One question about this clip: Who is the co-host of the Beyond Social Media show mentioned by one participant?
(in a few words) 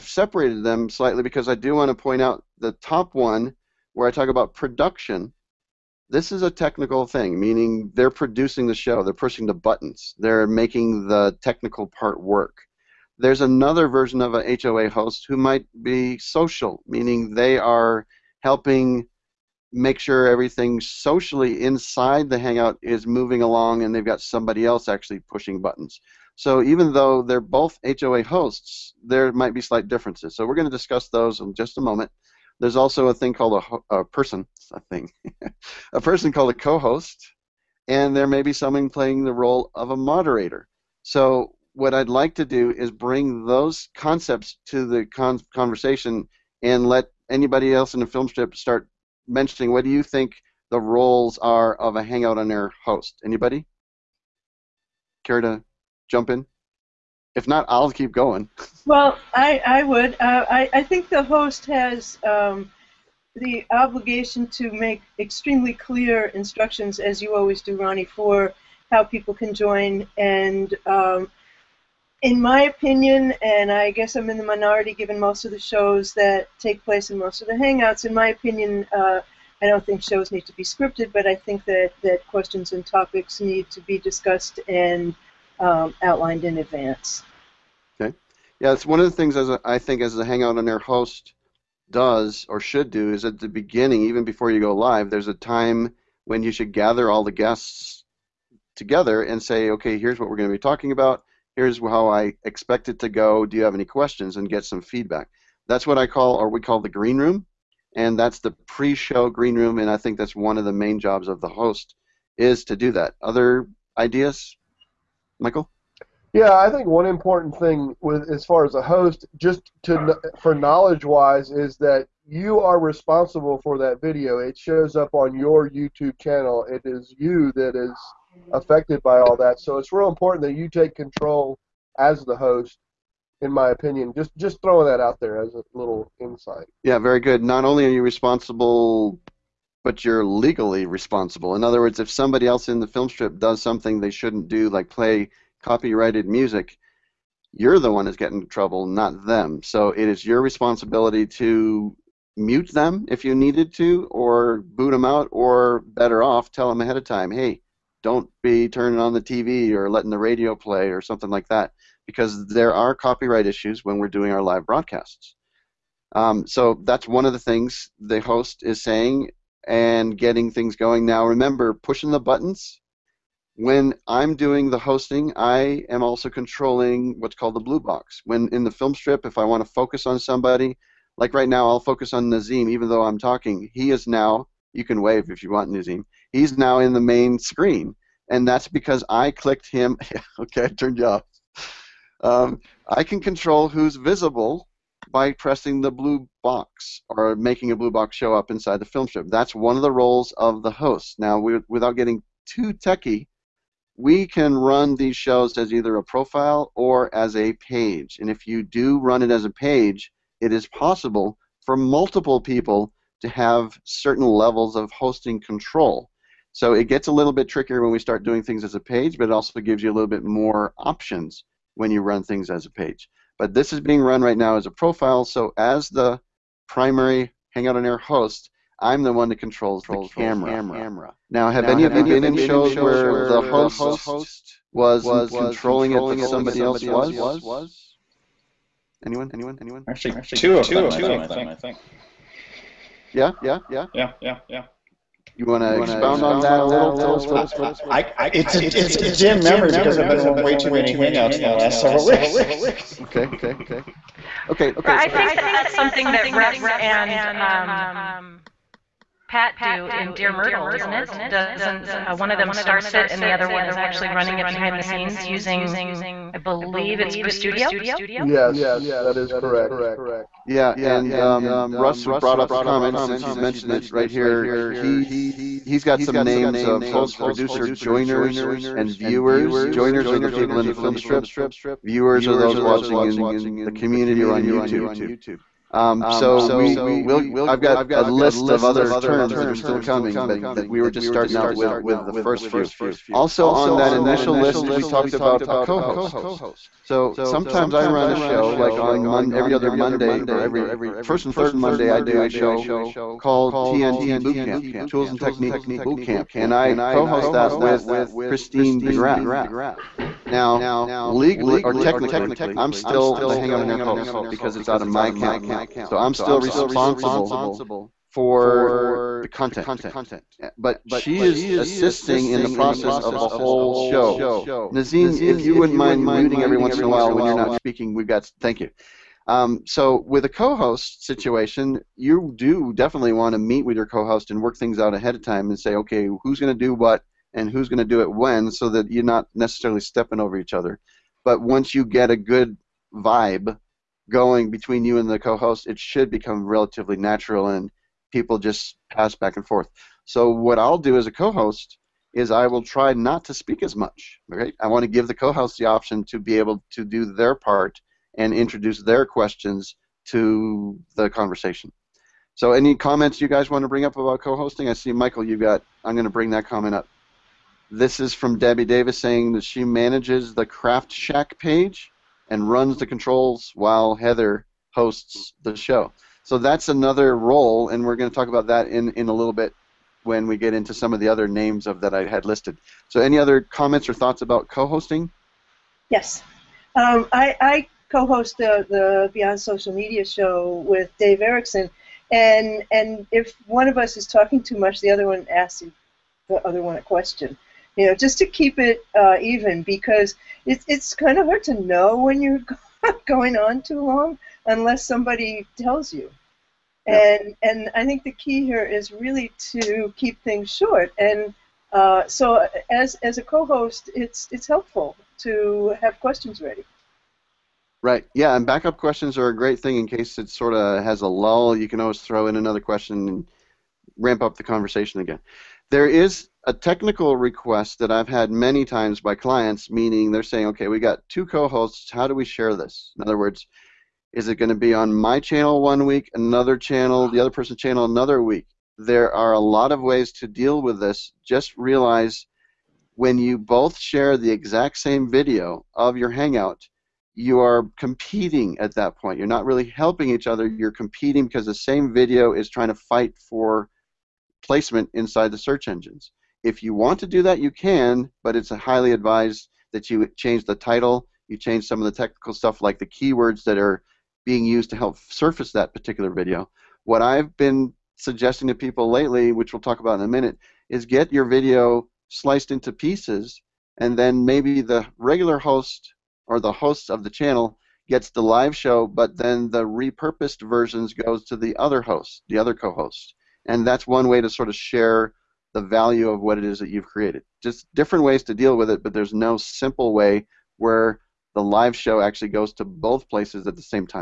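Dave Erickson.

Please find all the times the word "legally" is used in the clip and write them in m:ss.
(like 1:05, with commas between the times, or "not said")
2:20, 5:11.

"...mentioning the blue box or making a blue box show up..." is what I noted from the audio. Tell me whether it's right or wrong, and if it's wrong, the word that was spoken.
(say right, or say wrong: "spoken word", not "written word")
wrong: "pressing", not "mentioning".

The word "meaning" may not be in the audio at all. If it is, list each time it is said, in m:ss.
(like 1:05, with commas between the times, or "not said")
0:07, 0:16, 7:09.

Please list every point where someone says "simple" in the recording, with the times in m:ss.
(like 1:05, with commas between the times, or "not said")
8:09.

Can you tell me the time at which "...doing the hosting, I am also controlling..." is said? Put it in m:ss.
2:54.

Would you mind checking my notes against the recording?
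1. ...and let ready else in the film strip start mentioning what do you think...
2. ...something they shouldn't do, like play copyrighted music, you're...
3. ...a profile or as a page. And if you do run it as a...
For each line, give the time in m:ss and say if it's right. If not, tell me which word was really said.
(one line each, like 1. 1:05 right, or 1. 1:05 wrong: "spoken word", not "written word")
1. 0:46 wrong: "anybody", not "ready"
2. 2:23 right
3. 3:25 right.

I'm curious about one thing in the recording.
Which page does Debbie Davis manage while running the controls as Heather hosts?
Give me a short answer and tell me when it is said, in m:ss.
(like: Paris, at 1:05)
Craft Shack, at 6:10.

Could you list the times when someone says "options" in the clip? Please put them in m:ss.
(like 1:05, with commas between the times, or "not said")
3:40, 5:55.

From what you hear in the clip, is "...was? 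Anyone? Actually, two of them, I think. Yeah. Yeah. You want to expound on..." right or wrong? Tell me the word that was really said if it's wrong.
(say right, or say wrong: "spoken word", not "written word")
right.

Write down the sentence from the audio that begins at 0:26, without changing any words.
So even though they're both HOA hosts, there might be slight differences.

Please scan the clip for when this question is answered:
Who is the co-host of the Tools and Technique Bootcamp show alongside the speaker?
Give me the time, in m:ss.
5:08.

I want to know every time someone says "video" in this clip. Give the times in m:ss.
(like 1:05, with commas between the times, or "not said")
2:04, 7:25, 7:31, 7:46, 7:51.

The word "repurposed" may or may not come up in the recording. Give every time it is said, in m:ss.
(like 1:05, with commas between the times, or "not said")
7:59.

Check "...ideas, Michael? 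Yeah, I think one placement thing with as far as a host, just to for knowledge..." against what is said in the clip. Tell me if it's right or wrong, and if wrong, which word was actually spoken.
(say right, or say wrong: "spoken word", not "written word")
wrong: "important", not "placement".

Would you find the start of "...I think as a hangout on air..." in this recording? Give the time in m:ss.
1:29.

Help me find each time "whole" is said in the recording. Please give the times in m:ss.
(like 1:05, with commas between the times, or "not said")
5:23.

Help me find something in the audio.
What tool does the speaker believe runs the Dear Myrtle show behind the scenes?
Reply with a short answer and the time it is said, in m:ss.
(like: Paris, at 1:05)
Studio, at 4:27.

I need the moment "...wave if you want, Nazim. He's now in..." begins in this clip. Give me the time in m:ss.
3:05.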